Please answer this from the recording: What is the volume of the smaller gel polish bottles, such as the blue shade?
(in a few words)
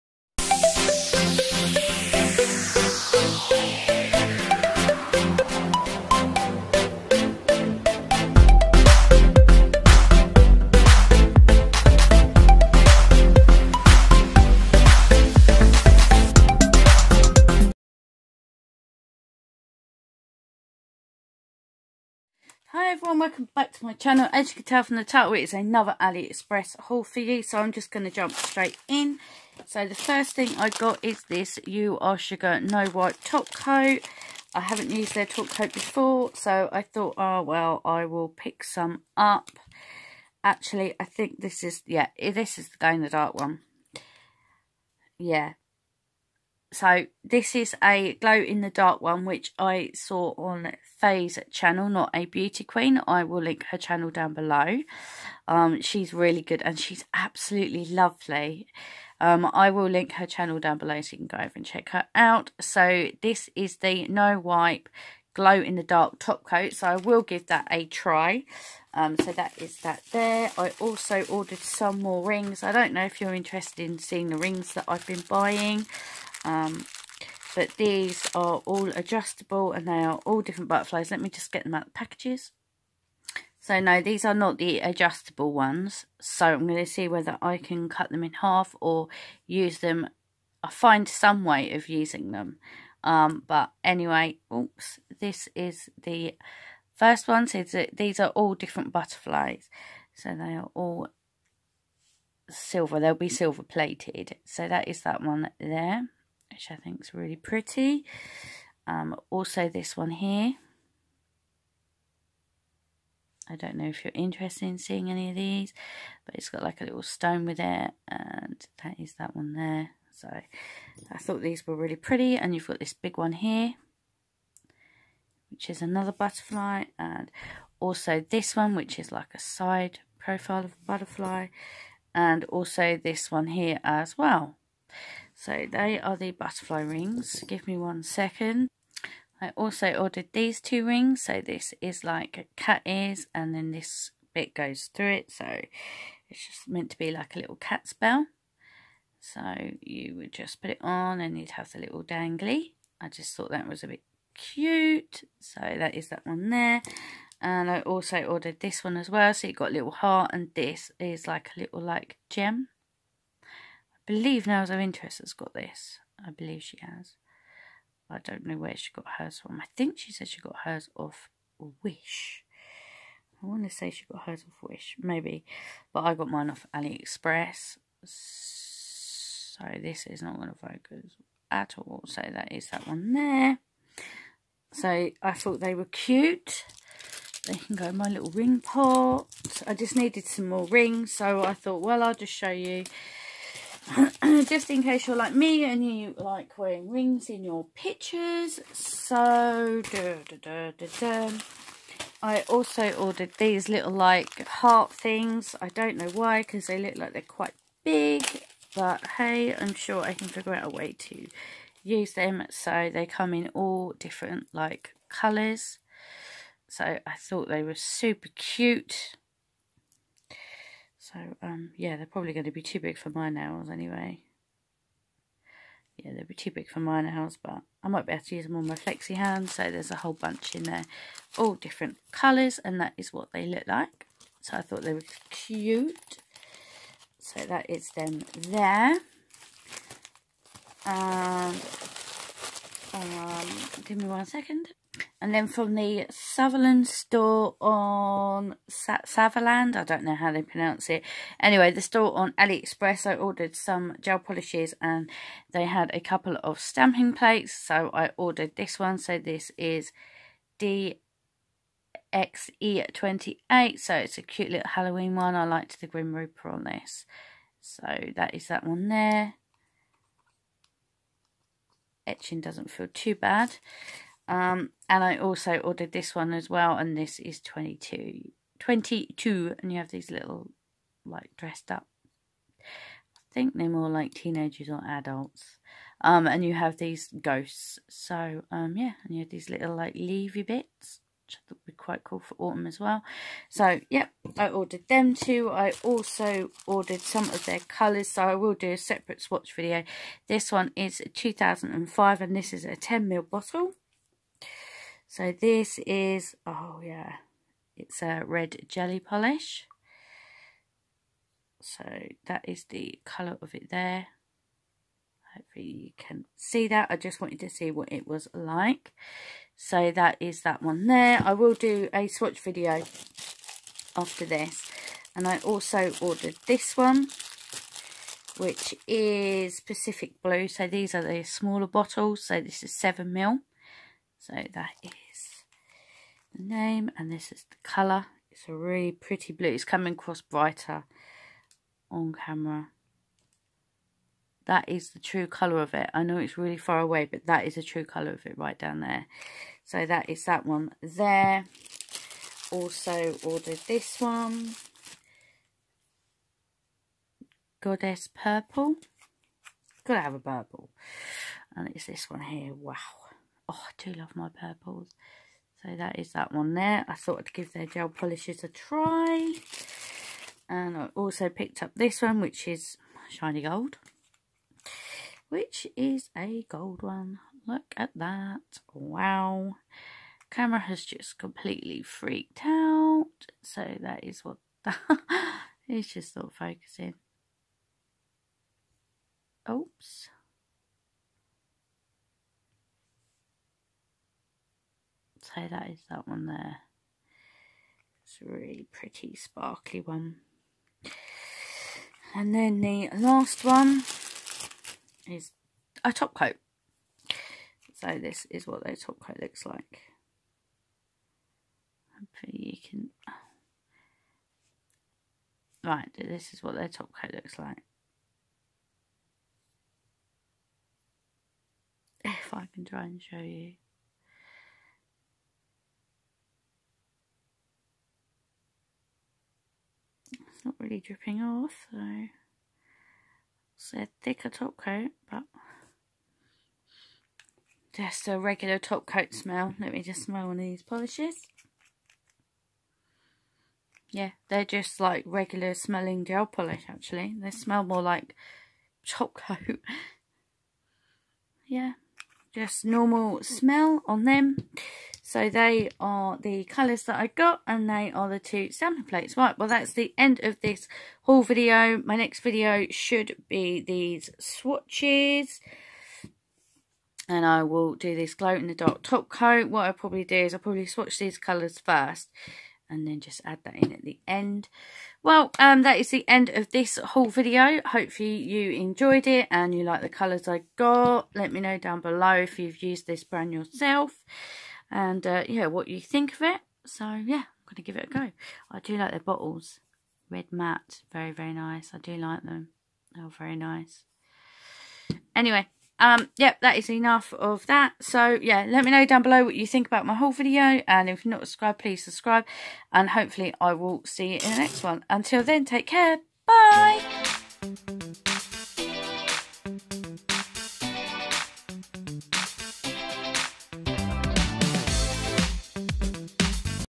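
7ml.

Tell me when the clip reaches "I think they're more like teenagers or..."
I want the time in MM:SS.
04:43.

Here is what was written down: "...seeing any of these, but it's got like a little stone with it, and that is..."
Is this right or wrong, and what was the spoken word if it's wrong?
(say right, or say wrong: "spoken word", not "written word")
right.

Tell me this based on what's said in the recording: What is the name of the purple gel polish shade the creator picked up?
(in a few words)
Goddess Purple.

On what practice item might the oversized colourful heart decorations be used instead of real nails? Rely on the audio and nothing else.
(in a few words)
Flexi hands.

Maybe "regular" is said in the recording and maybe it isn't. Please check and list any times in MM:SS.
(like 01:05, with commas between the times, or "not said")
07:18, 07:25.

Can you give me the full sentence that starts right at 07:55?
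Well, um, that is the end of this haul video.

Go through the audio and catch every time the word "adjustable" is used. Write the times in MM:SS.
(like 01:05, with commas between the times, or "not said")
01:18, 01:24.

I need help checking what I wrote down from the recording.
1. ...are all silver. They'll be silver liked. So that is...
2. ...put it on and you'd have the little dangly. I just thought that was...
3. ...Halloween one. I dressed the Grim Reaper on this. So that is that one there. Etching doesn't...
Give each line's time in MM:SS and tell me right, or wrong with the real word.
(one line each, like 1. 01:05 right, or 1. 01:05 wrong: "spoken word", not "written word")
1. 01:40 wrong: "plated", not "liked"
2. 02:30 right
3. 04:24 wrong: "liked", not "dressed".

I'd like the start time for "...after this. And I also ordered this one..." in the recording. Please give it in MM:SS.
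05:23.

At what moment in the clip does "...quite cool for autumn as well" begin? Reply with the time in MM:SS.
04:51.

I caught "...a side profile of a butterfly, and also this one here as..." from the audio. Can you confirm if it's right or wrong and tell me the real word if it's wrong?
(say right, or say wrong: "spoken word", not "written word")
right.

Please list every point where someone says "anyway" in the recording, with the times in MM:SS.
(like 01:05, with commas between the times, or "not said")
01:33, 03:43, 04:11, 08:15.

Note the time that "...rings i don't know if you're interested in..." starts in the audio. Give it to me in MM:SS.
01:12.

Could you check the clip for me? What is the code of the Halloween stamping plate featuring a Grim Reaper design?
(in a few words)
DXE28.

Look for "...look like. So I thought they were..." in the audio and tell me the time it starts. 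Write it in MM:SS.
03:53.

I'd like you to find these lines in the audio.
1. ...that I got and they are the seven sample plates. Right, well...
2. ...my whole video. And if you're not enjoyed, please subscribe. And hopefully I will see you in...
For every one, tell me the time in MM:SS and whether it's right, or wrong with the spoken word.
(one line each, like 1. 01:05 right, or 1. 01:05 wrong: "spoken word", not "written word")
1. 07:36 wrong: "two", not "seven"
2. 08:19 wrong: "subscribed", not "enjoyed".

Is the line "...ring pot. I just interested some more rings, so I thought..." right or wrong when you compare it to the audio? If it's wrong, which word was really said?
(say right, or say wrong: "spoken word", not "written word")
wrong: "needed", not "interested".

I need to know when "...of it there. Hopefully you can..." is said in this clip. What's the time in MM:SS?
05:13.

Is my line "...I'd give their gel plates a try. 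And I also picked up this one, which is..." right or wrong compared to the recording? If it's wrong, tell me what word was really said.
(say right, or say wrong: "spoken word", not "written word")
wrong: "polishes", not "plates".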